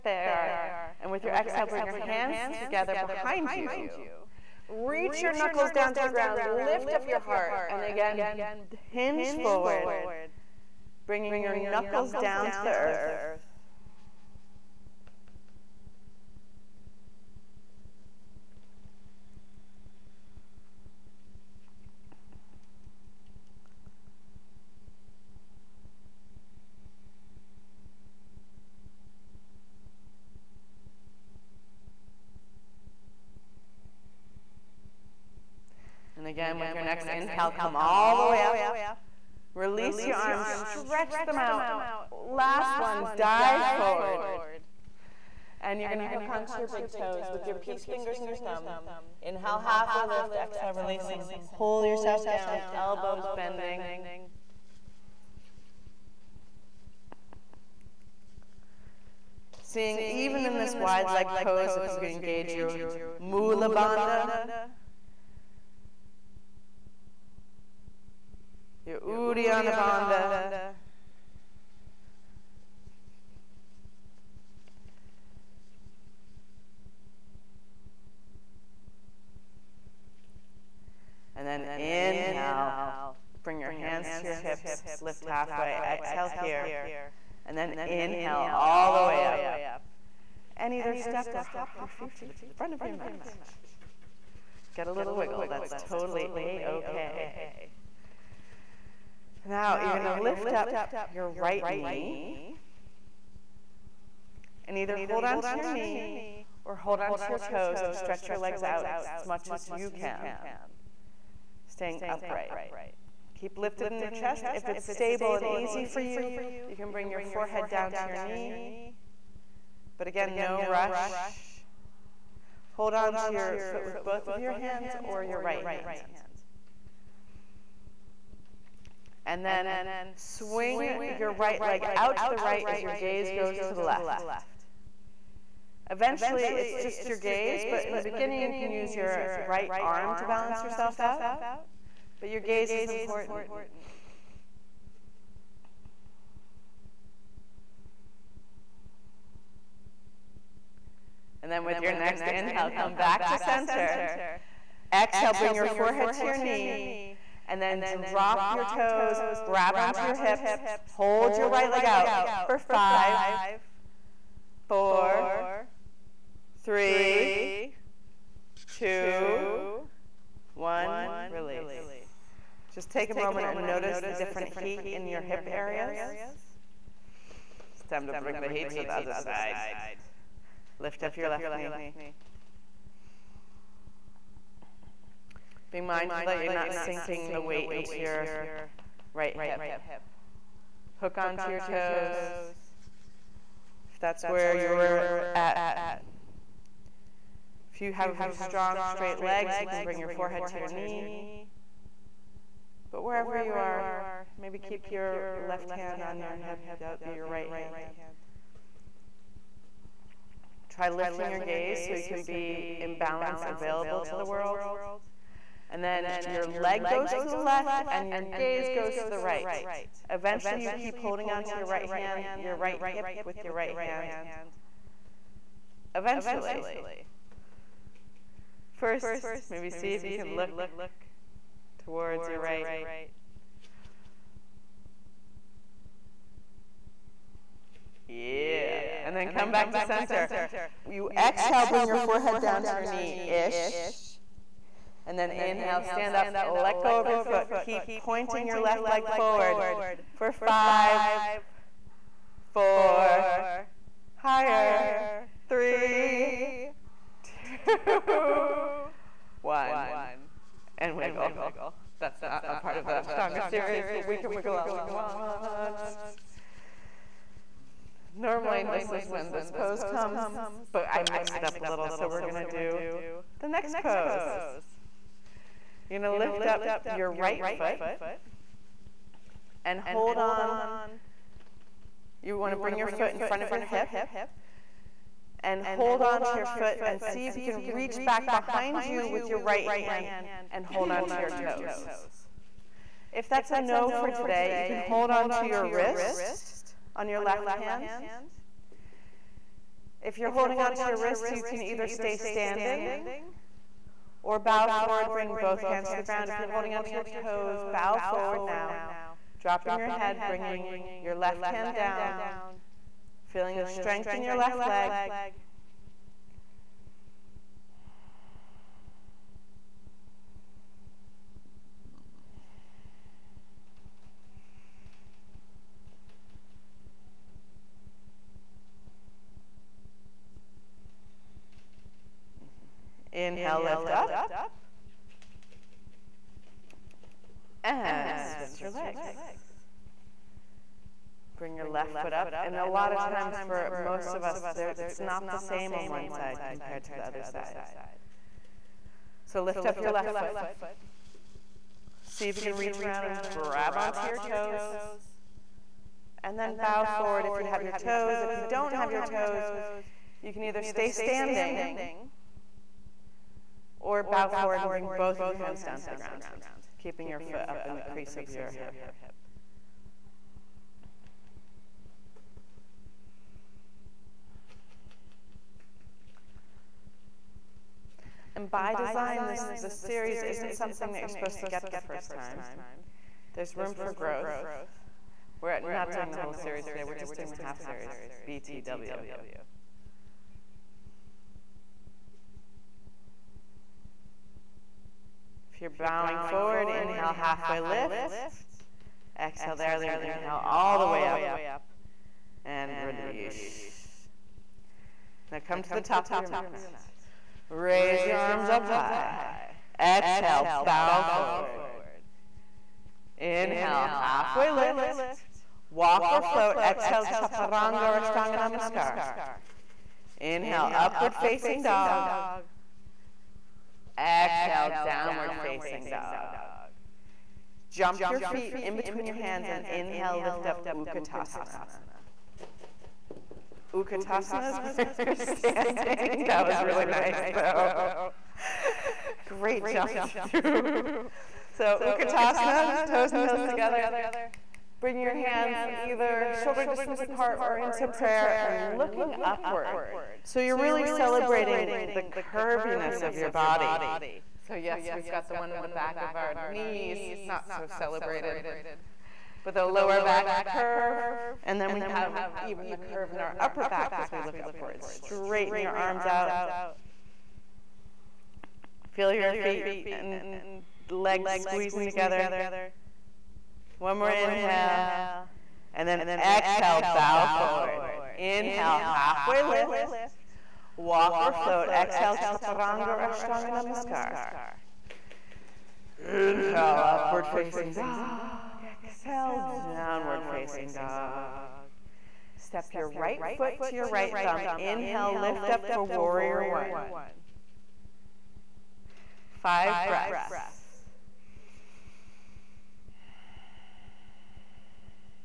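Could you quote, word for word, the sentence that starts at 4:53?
If that's a no for today, you can hold on to your wrist on your left hand.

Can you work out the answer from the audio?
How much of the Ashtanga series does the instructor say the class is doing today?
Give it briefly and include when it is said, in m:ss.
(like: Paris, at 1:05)
Half series, at 6:27.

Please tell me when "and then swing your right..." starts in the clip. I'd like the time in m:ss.
2:09.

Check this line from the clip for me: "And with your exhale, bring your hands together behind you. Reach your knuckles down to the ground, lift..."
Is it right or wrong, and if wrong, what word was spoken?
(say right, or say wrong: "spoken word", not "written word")
right.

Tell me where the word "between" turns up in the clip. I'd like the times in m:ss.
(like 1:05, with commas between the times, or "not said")
7:08.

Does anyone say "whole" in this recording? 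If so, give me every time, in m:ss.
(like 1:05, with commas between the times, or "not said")
6:26.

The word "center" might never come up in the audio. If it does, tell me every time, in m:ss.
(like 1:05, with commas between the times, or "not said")
2:33, 3:59.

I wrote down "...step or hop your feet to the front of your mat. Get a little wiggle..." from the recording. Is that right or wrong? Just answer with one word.
right.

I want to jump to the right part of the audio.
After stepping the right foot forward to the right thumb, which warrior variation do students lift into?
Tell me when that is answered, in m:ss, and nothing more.
8:15.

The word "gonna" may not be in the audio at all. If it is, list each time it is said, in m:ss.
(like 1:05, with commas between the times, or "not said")
0:45, 4:32.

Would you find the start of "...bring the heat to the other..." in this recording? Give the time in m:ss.
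2:58.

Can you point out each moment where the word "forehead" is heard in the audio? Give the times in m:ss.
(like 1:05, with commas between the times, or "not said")
1:57, 2:35, 3:20, 4:01.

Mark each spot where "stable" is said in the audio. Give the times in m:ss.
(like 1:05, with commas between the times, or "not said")
1:54.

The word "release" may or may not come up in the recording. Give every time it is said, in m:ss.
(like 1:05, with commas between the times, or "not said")
0:39, 0:50, 2:51, 6:42.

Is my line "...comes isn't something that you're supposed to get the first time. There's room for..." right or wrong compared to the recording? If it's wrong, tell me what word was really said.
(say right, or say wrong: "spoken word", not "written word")
wrong: "series", not "comes".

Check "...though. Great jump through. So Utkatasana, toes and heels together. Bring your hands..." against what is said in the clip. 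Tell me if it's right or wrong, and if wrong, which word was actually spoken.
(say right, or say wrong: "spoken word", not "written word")
right.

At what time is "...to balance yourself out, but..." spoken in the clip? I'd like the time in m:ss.
2:20.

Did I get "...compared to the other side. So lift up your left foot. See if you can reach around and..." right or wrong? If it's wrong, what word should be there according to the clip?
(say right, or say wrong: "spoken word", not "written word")
right.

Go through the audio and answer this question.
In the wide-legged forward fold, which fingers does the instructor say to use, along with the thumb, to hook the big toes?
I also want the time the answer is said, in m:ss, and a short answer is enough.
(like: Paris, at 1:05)
Peace fingers, at 0:47.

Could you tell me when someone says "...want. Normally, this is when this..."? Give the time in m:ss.
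4:24.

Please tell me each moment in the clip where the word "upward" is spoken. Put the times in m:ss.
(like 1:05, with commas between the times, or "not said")
7:00, 7:29, 7:44, 8:06.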